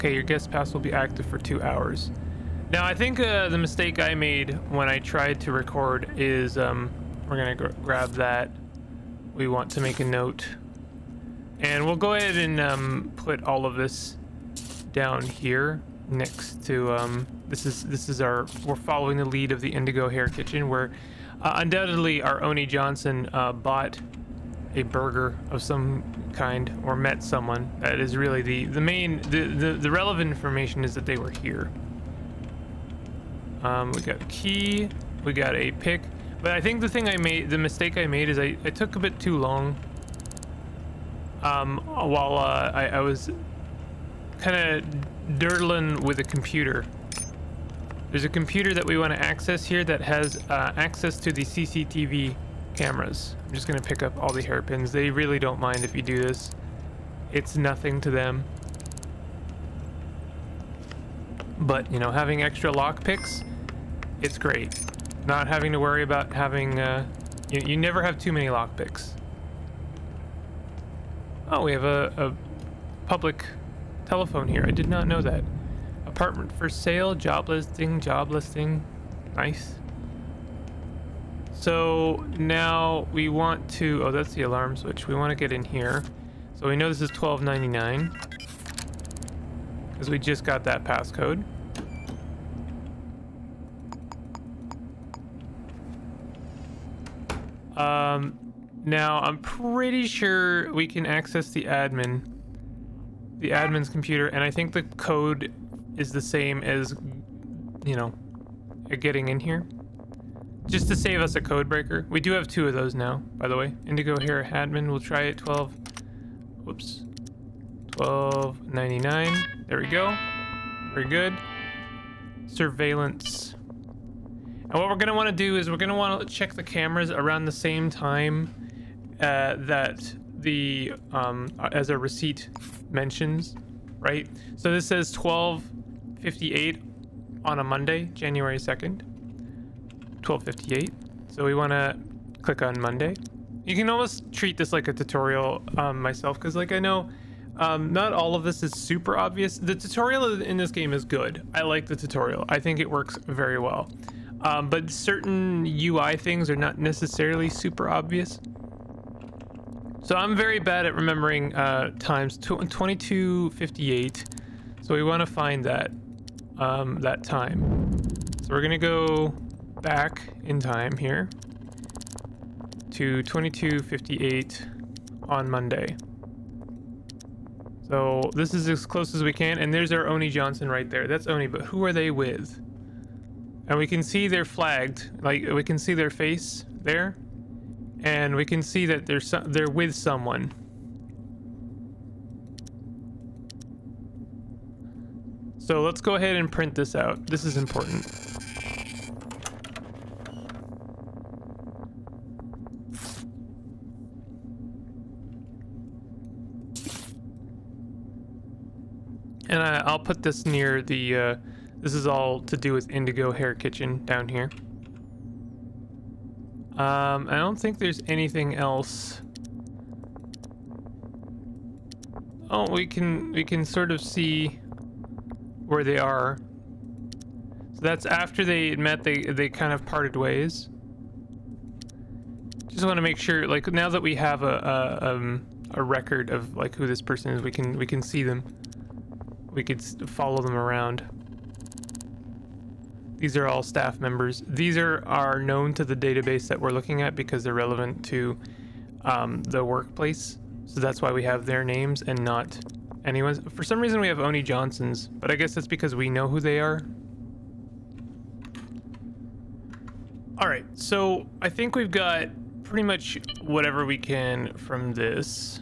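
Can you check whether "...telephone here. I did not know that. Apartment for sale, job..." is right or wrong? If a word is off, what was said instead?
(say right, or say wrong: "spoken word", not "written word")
right.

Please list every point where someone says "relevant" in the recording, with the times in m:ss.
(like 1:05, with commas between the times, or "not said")
0:29, 4:07.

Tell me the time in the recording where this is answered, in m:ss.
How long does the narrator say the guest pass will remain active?
0:01.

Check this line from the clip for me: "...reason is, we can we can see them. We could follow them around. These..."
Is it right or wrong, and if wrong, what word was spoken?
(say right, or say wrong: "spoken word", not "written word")
wrong: "person", not "reason".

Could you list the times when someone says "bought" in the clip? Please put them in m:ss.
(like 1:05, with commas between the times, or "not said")
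0:23.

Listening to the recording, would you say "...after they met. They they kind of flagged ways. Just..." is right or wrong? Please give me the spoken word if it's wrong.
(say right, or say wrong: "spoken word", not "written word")
wrong: "parted", not "flagged".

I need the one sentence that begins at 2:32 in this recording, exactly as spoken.
I think it works very well.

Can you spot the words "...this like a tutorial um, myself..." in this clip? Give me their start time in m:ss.
2:24.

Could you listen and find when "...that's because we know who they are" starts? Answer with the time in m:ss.
4:15.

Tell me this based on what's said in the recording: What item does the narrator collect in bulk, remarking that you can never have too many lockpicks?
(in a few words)
hairpins.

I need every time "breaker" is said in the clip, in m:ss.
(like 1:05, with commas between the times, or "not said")
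1:51.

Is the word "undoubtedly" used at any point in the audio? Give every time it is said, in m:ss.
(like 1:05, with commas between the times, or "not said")
0:21.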